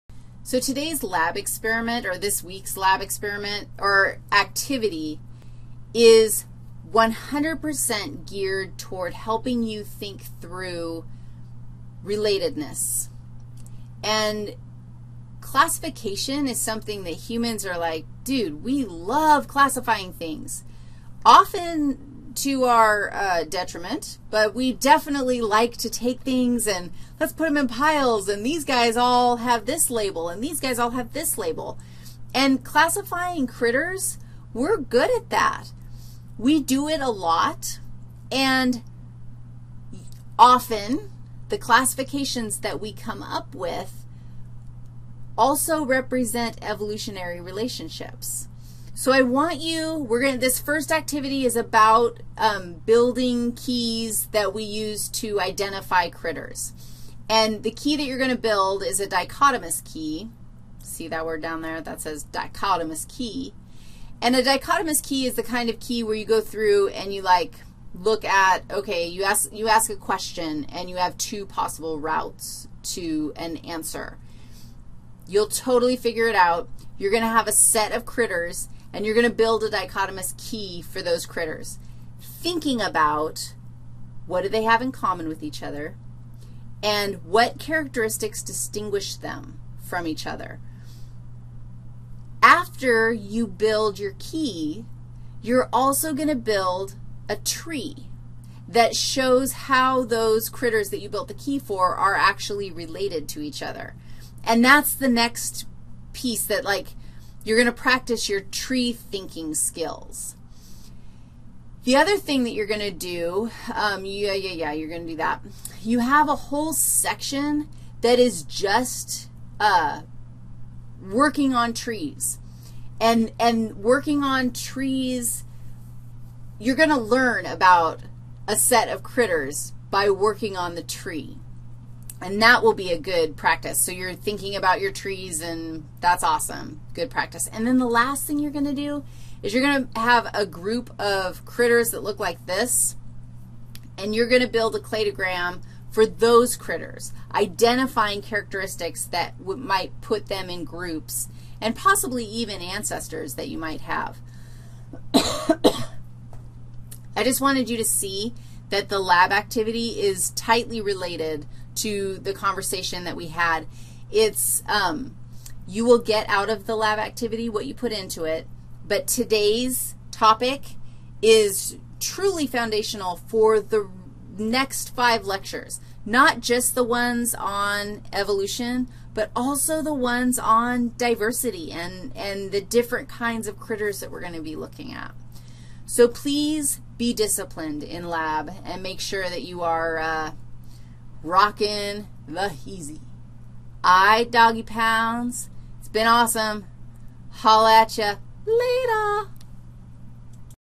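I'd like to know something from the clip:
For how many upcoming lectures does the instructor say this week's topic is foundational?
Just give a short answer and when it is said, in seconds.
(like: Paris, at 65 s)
5, at 174 s.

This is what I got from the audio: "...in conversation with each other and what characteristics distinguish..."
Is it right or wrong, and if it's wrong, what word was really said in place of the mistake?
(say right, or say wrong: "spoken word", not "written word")
wrong: "common", not "conversation".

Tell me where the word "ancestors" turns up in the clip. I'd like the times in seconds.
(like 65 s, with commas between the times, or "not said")
152 s.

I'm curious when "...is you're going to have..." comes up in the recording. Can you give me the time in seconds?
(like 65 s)
139 s.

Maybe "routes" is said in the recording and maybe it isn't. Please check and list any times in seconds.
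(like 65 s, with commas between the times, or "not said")
71 s.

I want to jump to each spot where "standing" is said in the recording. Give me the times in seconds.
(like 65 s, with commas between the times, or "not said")
not said.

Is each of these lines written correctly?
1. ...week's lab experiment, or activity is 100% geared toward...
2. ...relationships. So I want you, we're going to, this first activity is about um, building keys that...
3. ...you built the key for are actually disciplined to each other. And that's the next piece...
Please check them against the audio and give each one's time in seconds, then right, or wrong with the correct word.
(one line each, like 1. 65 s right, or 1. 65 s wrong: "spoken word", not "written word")
1. 2 s right
2. 47 s right
3. 101 s wrong: "related", not "disciplined".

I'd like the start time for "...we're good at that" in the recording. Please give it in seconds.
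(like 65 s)
34 s.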